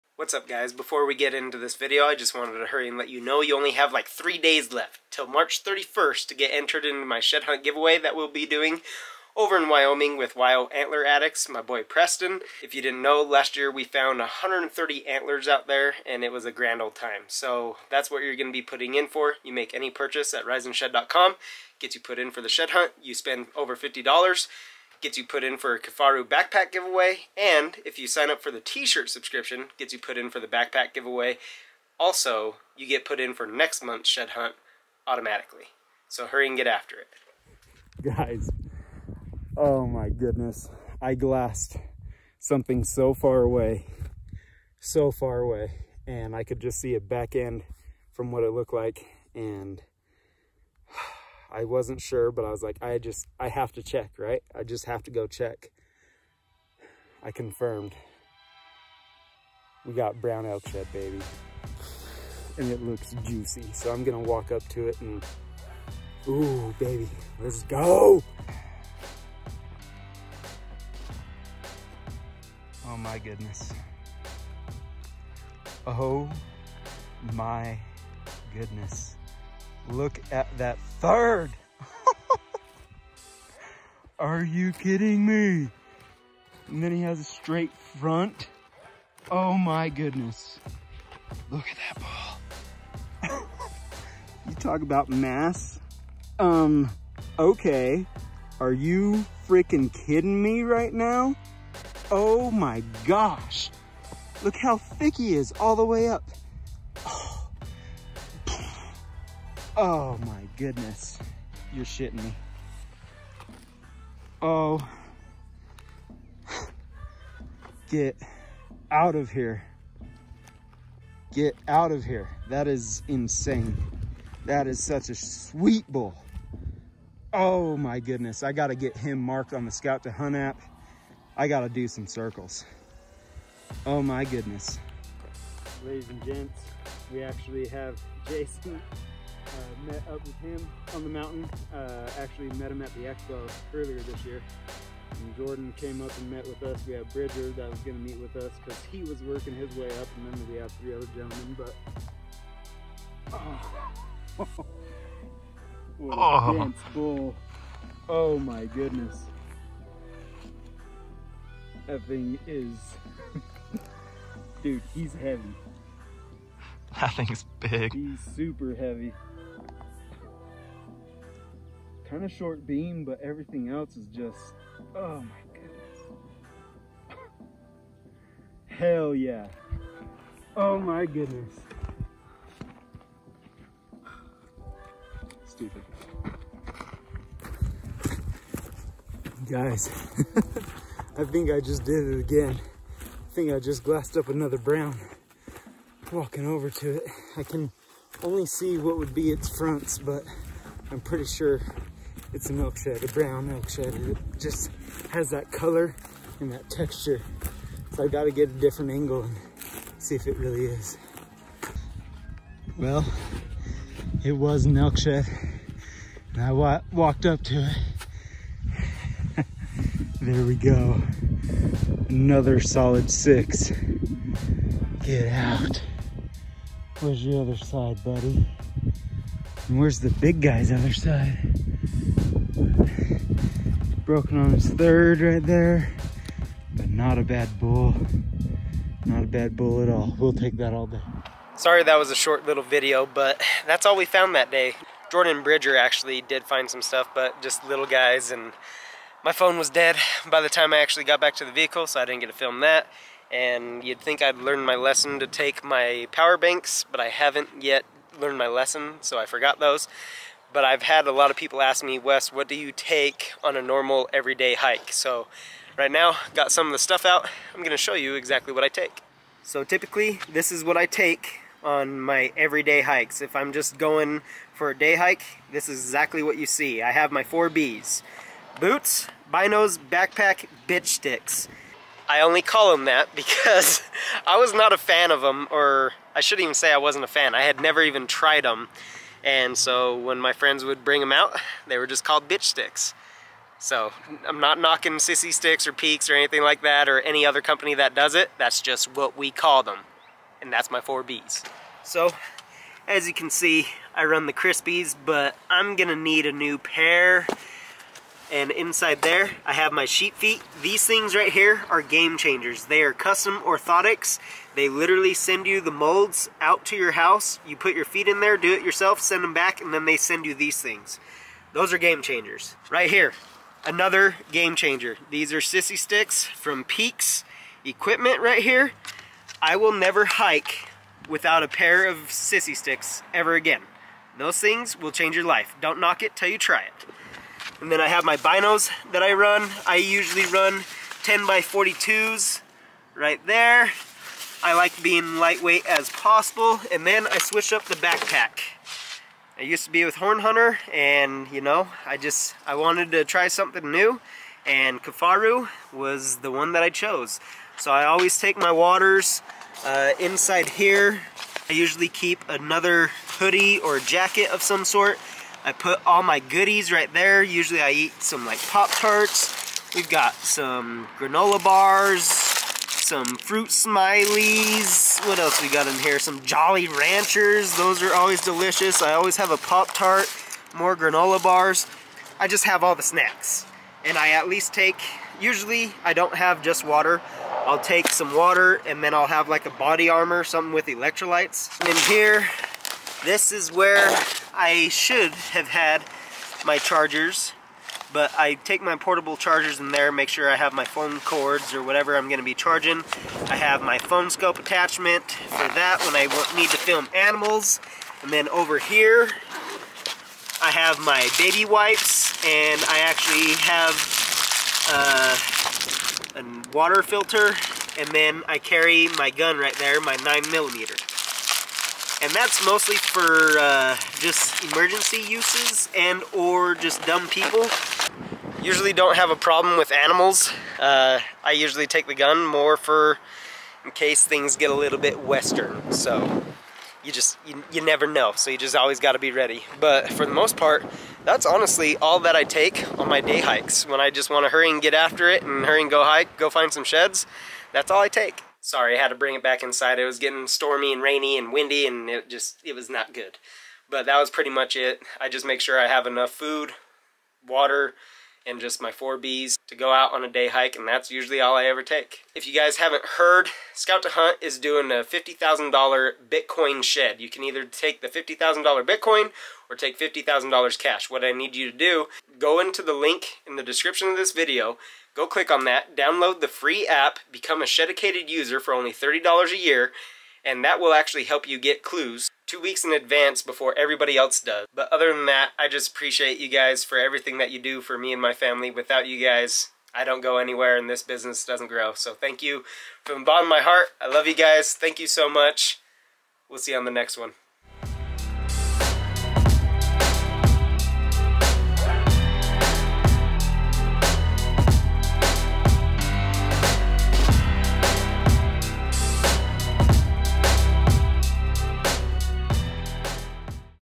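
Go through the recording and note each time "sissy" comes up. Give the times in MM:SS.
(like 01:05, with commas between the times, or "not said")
04:54, 05:25, 05:32.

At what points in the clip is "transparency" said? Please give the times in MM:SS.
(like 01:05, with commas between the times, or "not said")
not said.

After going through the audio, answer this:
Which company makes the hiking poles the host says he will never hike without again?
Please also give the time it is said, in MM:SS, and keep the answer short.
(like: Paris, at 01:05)
Peax Equipment, at 05:26.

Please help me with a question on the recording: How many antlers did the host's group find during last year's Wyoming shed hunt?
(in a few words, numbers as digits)
130.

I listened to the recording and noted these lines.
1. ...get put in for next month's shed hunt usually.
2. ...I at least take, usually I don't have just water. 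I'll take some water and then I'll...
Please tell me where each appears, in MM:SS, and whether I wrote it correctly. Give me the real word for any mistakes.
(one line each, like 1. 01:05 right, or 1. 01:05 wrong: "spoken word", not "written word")
1. 00:32 wrong: "automatically", not "usually"
2. 06:23 right.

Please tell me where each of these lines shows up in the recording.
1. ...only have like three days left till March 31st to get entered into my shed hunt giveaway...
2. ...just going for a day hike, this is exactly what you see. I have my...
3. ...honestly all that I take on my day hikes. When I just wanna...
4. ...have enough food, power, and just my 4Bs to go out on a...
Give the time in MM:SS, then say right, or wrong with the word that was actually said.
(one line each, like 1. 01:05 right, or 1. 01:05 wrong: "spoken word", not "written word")
1. 00:03 right
2. 04:33 right
3. 07:21 right
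4. 07:35 wrong: "water", not "power".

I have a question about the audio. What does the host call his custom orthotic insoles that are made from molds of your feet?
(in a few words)
sheep feet.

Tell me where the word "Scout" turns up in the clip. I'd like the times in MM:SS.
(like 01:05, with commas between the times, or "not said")
02:09, 07:43.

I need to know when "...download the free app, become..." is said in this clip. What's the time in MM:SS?
07:55.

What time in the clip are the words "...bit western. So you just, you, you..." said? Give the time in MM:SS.
07:14.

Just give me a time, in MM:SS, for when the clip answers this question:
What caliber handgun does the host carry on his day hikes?
06:59.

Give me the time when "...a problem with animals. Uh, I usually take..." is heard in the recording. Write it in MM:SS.
07:09.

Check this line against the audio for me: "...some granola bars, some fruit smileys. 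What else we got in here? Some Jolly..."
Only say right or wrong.
right.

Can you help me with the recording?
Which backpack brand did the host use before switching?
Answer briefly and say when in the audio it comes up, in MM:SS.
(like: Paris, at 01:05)
Horn Hunter, at 05:49.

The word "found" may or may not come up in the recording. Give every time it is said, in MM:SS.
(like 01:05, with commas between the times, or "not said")
00:13, 04:04.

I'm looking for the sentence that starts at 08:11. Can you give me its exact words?
So thank you from the bottom of my heart.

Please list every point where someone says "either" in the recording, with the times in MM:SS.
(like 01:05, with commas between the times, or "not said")
07:47.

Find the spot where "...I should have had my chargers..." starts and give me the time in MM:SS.
06:34.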